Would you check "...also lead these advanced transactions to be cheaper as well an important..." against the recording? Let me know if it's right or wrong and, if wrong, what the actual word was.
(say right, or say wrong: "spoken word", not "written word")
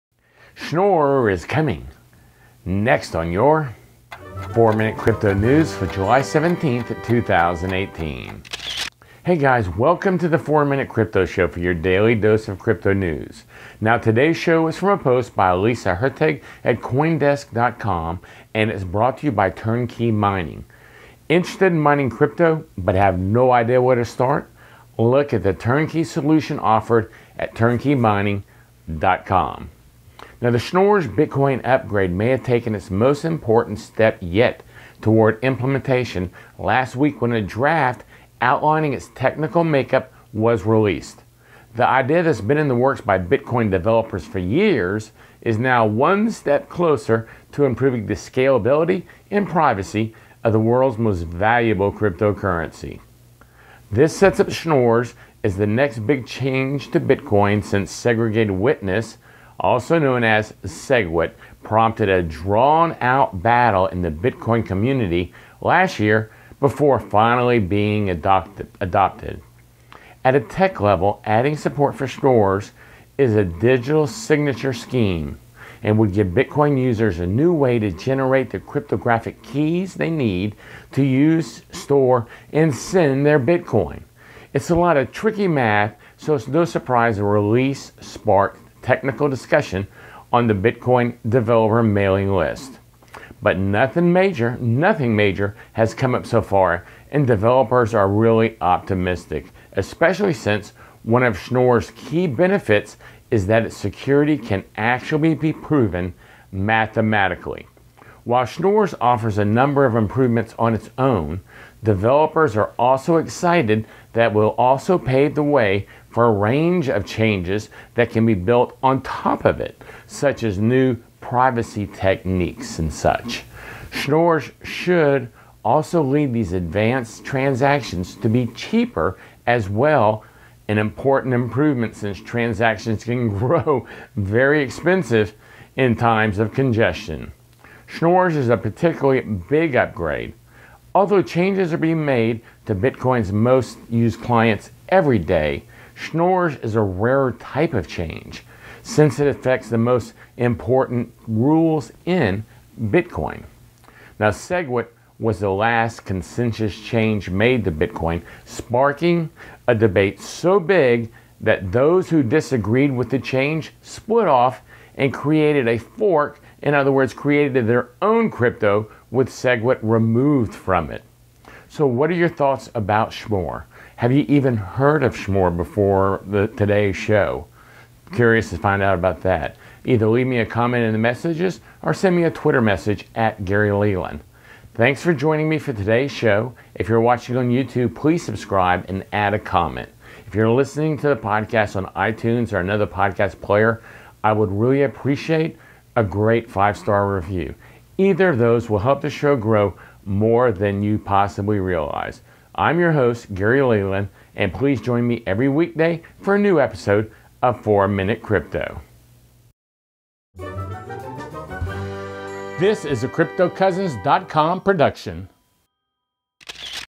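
right.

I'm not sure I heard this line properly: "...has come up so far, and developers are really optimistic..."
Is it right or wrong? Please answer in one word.
right.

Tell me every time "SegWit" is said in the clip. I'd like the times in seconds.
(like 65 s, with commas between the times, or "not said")
60 s, 154 s, 169 s.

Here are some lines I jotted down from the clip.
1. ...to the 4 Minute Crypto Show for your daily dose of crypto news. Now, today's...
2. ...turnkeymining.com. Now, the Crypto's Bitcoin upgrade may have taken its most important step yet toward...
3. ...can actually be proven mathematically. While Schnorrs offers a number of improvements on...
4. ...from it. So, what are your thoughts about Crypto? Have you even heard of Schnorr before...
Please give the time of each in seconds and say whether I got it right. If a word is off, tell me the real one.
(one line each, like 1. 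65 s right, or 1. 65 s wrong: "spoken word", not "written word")
1. 10 s right
2. 27 s wrong: "Schnorr", not "Crypto"
3. 104 s right
4. 170 s wrong: "Schnorr", not "Crypto".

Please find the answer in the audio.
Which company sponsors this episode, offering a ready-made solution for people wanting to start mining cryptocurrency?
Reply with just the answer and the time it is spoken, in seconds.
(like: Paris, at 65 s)
Turnkey Mining, at 19 s.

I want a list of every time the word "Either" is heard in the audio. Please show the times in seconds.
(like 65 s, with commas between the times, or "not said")
179 s, 197 s.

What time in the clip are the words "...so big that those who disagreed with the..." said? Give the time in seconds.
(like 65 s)
160 s.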